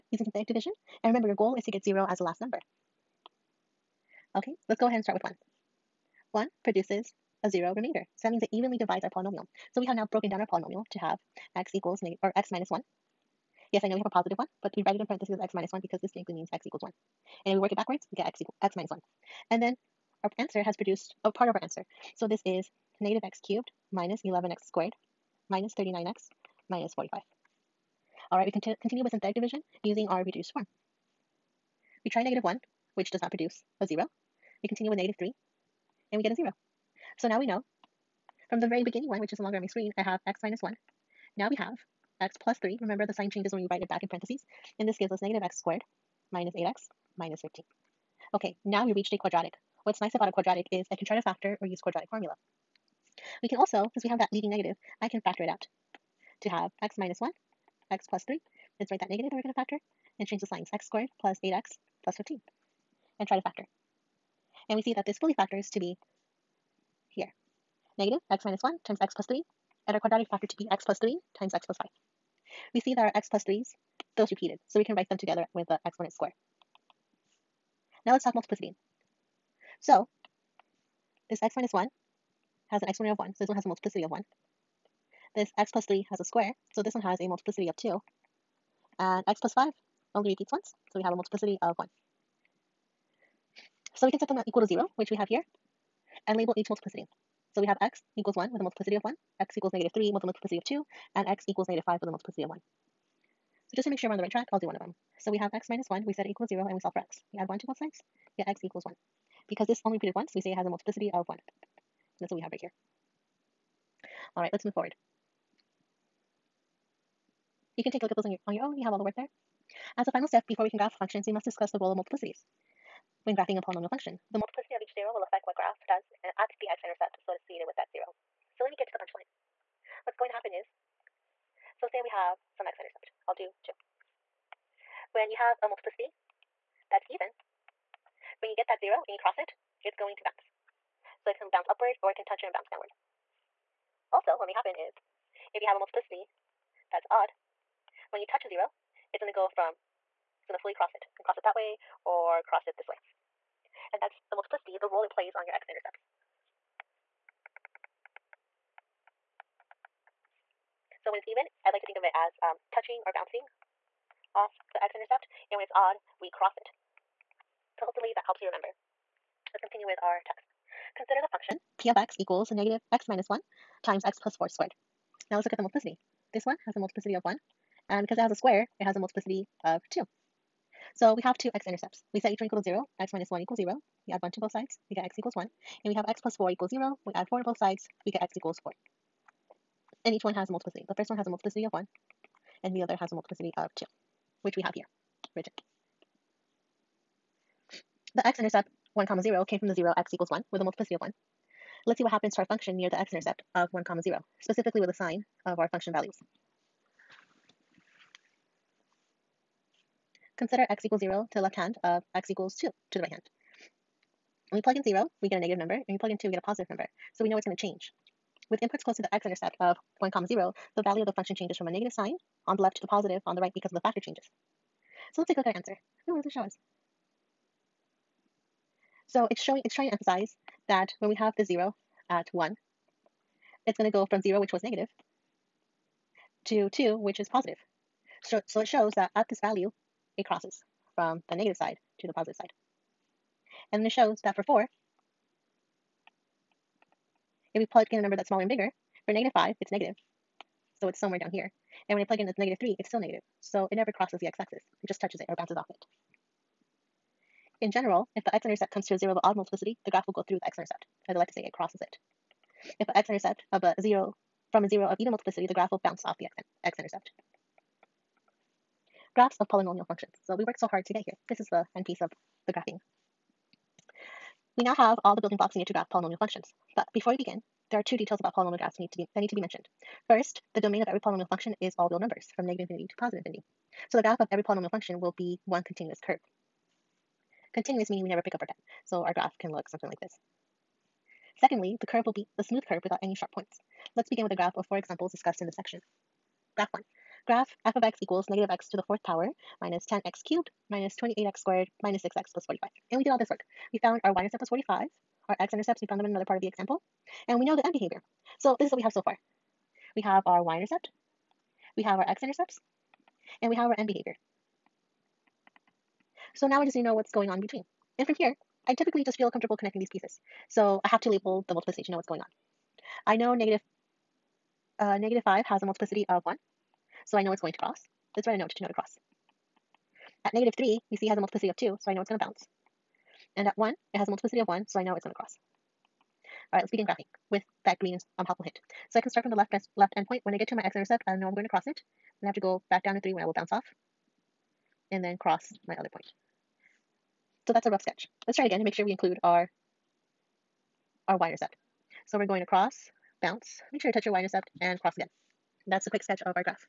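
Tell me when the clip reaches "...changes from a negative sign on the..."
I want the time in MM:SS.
03:41.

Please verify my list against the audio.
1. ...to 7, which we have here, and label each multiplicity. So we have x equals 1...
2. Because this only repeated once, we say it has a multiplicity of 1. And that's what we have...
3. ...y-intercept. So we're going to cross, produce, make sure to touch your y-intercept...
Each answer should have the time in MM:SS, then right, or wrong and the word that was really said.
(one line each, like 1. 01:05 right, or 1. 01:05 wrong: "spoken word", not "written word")
1. 01:34 wrong: "0", not "7"
2. 01:49 right
3. 05:51 wrong: "bounce", not "produce".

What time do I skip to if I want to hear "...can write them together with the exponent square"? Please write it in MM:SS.
01:14.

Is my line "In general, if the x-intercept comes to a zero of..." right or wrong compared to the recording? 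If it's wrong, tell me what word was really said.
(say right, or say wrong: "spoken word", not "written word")
right.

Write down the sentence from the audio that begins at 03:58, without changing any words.
So, so it shows that at this value, it crosses from the negative side to the positive side.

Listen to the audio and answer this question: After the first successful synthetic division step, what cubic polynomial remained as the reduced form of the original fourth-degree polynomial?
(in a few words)
-x^3 - 11x^2 - 39x - 45.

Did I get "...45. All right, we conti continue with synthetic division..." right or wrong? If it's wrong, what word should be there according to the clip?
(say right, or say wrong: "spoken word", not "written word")
right.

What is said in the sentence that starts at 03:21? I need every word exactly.
Let's see what happens to our function near the x-intercept of 1 comma 0, specifically with the sign of our function values.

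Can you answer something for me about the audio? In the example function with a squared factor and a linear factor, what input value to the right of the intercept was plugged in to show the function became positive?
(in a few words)
2.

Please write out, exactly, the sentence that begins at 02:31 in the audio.
You can cross it that way or cross it this way.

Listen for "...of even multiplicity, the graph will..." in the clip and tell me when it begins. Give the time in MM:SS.
04:24.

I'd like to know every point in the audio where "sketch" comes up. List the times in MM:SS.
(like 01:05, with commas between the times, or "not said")
05:47, 05:56.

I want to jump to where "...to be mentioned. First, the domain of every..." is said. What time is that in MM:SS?
04:39.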